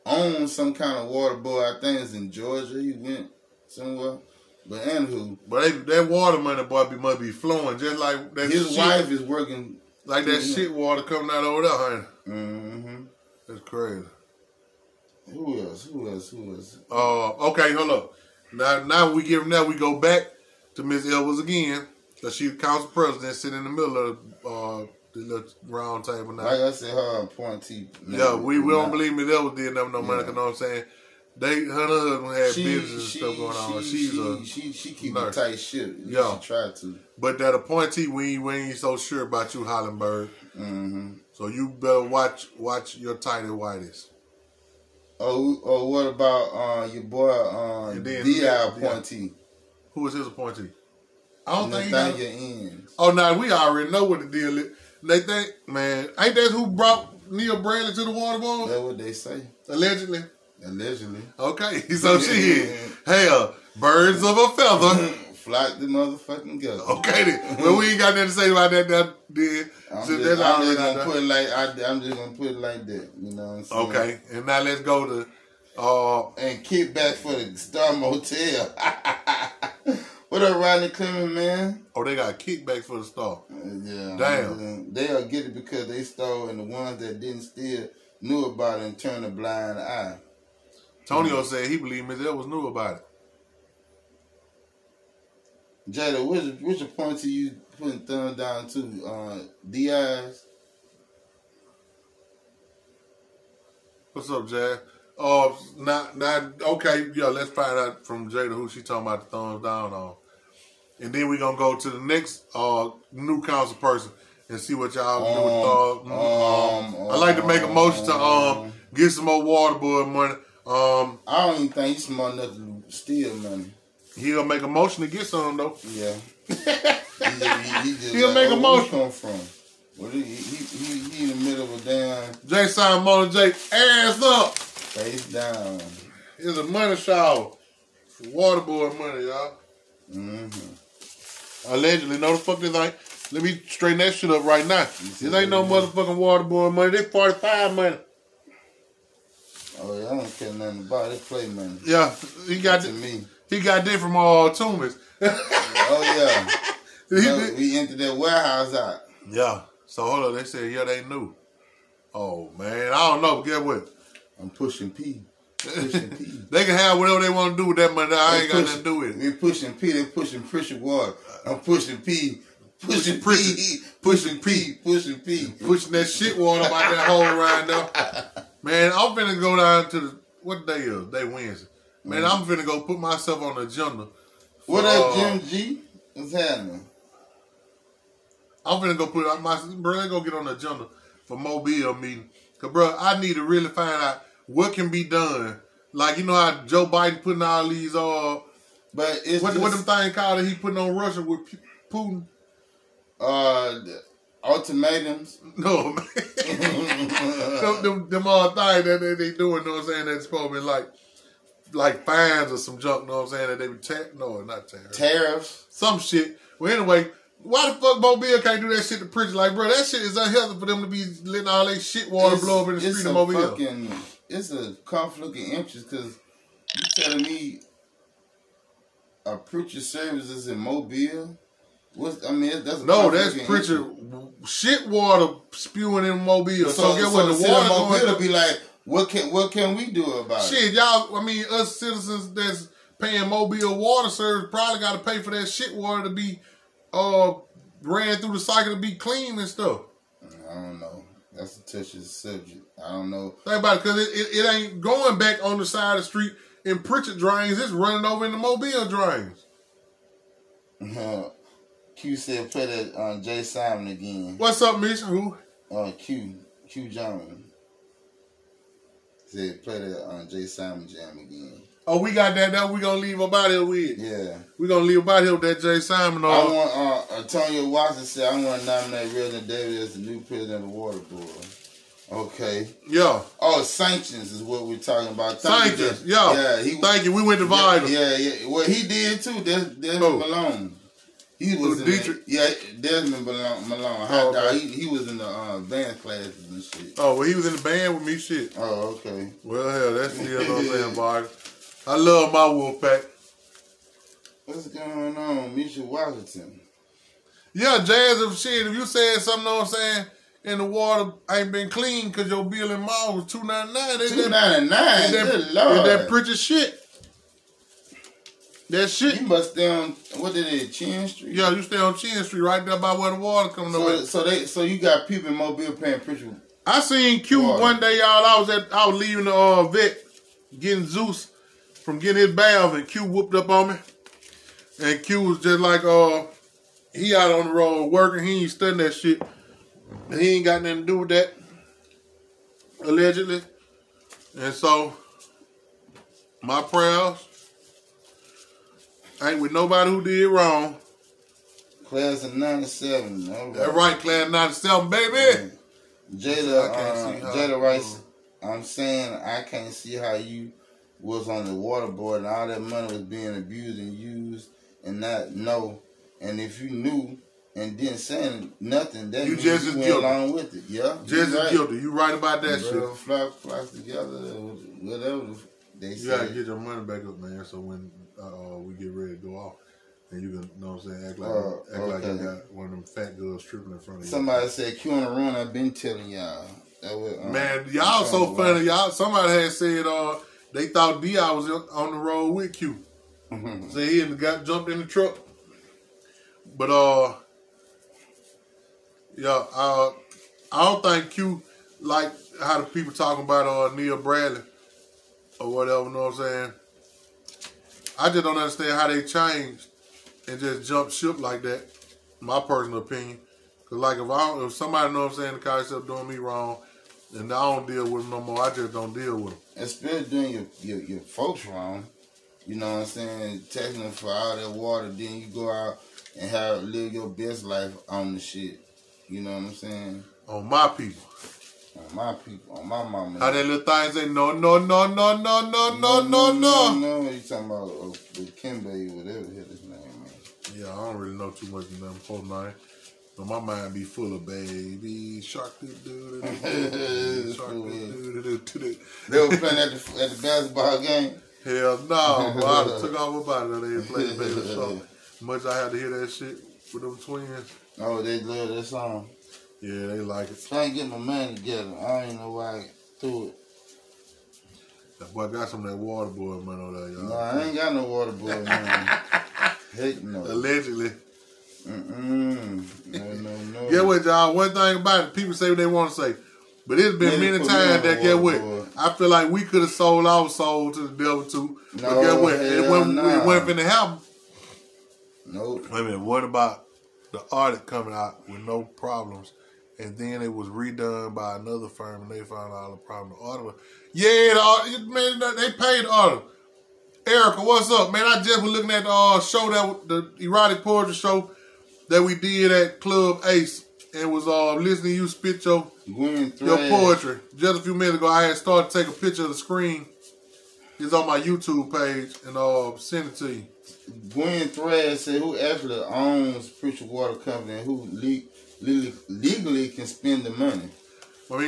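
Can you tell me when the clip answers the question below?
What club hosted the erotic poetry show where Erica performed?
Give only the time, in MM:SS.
08:22.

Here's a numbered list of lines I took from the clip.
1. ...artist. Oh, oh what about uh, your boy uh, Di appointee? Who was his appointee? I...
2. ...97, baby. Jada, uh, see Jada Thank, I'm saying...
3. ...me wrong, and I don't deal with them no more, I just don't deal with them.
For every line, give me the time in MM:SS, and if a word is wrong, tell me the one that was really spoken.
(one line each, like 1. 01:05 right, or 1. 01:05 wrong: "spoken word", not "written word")
1. 00:43 wrong: "whitest", not "artist"
2. 05:54 wrong: "Rice", not "Thank"
3. 06:56 right.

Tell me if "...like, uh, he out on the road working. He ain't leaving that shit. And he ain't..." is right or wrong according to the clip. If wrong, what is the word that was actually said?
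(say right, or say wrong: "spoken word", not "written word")
wrong: "studying", not "leaving".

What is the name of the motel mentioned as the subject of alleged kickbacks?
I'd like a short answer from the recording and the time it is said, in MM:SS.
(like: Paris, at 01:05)
Star Motel, at 01:17.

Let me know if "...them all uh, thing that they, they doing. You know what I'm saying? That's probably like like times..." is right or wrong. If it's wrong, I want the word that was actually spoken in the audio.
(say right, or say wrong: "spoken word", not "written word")
wrong: "fines", not "times".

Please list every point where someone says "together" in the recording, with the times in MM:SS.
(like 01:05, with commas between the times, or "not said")
06:13, 07:41.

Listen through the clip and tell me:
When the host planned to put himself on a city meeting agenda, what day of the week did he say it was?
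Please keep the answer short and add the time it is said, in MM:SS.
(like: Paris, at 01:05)
Wednesday, at 03:01.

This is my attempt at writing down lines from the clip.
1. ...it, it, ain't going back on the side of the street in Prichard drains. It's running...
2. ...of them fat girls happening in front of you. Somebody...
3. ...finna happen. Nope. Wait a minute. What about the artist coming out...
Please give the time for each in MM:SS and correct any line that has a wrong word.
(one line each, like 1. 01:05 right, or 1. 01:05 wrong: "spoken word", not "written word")
1. 04:14 right
2. 06:22 wrong: "tripping", not "happening"
3. 08:03 right.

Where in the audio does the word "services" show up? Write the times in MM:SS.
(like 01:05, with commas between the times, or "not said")
03:49, 04:04.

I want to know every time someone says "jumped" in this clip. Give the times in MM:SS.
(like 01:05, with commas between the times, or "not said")
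06:34, 06:50.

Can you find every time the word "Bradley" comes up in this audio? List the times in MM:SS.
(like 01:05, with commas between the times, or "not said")
00:57, 06:43.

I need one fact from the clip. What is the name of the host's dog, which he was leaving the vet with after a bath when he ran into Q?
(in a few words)
Zeus.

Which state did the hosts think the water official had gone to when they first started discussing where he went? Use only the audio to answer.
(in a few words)
Georgia.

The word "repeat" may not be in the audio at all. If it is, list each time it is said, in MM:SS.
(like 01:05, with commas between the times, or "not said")
not said.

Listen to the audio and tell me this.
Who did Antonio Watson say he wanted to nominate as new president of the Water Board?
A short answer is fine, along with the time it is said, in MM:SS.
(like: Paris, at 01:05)
Reverend David, at 04:39.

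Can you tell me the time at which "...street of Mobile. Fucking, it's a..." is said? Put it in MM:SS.
03:42.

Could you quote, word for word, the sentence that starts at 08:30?
It's on my YouTube page, and uh, send it to you.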